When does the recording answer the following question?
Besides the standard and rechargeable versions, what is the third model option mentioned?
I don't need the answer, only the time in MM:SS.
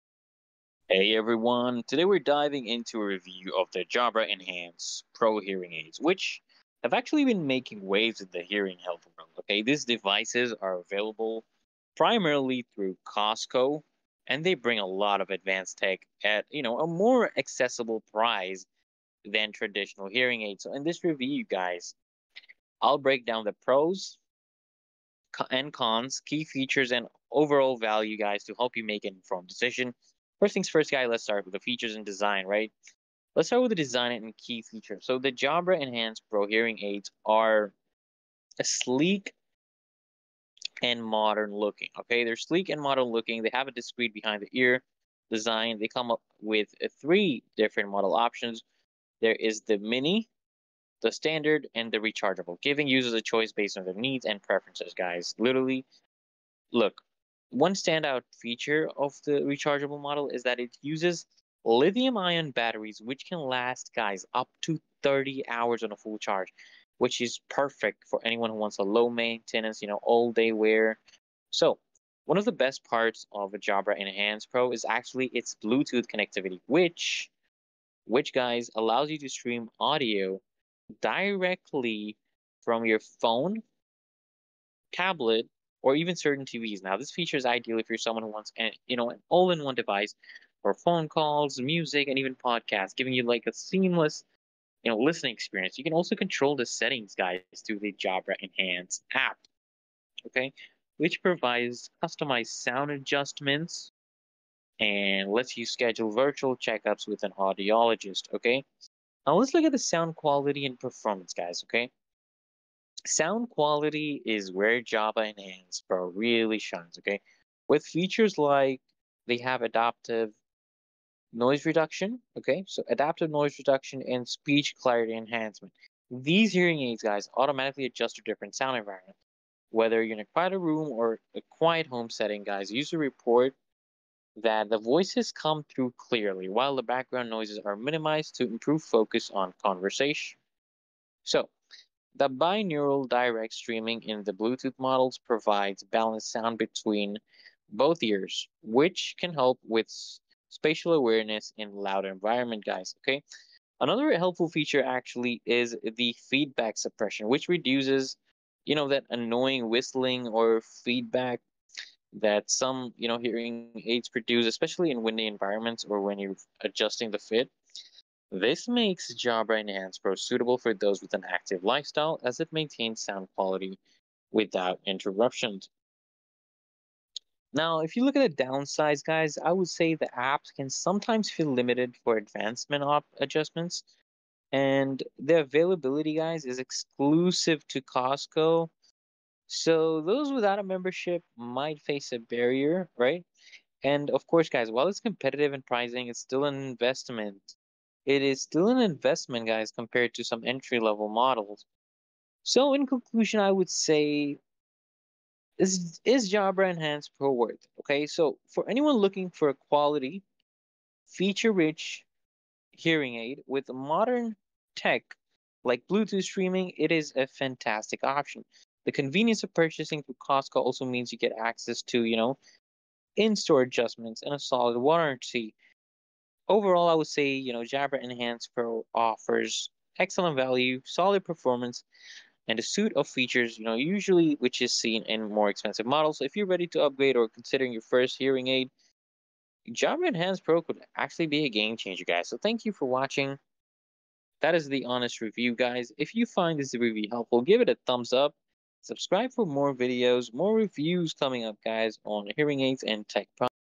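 00:49.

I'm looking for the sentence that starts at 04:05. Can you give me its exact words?
If you find this review helpful, give it a thumbs up.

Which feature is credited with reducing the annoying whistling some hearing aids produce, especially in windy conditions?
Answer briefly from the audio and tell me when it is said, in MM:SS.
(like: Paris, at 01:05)
Feedback suppression, at 02:36.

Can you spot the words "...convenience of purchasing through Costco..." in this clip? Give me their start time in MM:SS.
03:38.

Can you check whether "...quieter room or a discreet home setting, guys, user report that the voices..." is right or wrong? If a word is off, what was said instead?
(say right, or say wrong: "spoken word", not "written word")
wrong: "quiet", not "discreet".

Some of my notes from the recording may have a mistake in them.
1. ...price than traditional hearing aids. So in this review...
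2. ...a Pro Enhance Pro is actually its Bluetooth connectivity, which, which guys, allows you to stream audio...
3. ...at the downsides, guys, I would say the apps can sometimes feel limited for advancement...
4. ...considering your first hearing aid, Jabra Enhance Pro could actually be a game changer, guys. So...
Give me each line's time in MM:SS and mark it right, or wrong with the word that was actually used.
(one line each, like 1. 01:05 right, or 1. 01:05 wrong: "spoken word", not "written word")
1. 00:18 right
2. 01:13 wrong: "Jabra", not "Pro"
3. 02:58 right
4. 03:57 right.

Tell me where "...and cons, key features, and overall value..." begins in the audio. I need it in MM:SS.
00:25.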